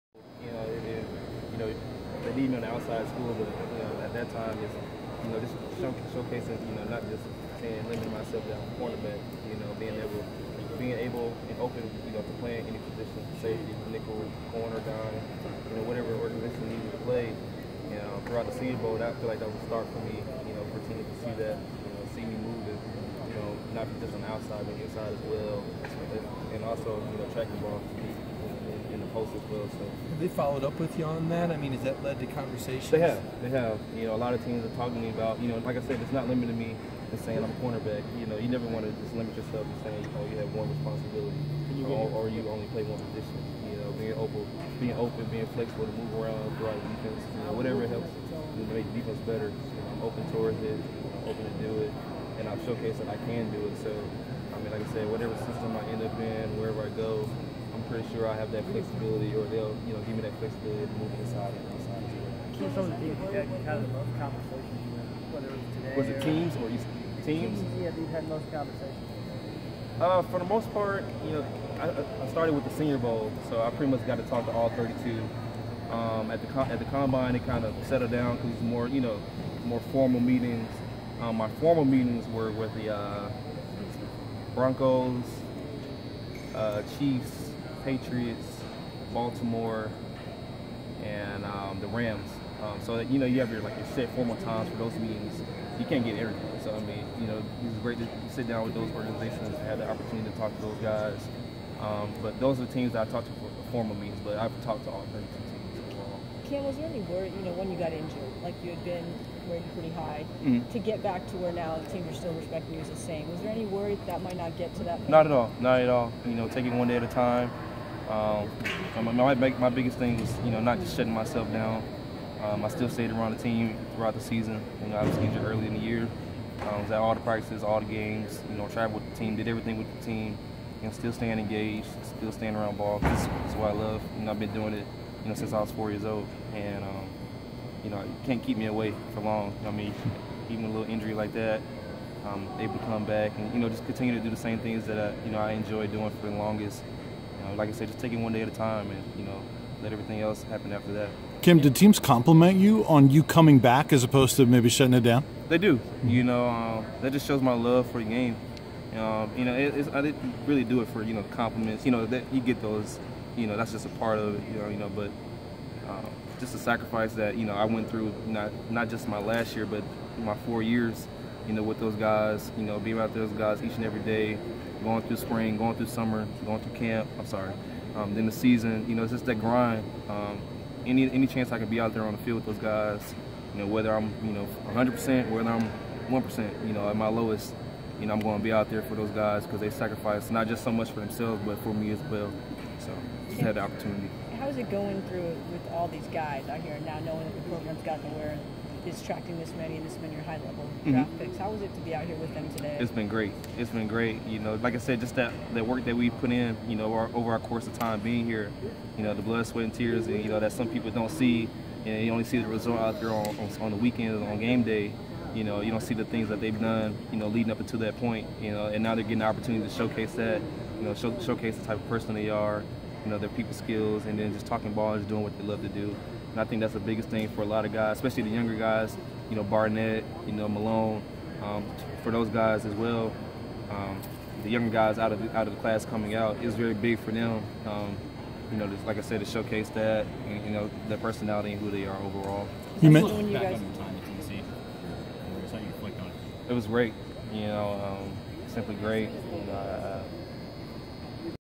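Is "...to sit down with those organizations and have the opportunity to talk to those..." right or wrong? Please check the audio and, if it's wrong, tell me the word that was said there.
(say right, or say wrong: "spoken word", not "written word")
right.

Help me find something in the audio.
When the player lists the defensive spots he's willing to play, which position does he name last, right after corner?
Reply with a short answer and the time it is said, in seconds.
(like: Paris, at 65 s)
dime, at 14 s.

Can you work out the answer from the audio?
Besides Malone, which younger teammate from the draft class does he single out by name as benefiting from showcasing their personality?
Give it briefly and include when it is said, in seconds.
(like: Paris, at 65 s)
Barnett, at 229 s.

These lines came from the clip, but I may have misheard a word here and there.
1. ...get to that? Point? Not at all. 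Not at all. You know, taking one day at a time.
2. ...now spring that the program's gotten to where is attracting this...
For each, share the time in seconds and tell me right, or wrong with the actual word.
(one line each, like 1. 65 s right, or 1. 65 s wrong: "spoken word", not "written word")
1. 114 s right
2. 196 s wrong: "knowing", not "spring".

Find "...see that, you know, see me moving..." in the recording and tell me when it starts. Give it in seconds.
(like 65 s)
21 s.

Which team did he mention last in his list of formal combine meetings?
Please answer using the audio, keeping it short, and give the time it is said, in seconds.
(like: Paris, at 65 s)
Rams, at 91 s.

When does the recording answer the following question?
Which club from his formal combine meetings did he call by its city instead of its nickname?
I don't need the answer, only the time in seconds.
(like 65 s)
89 s.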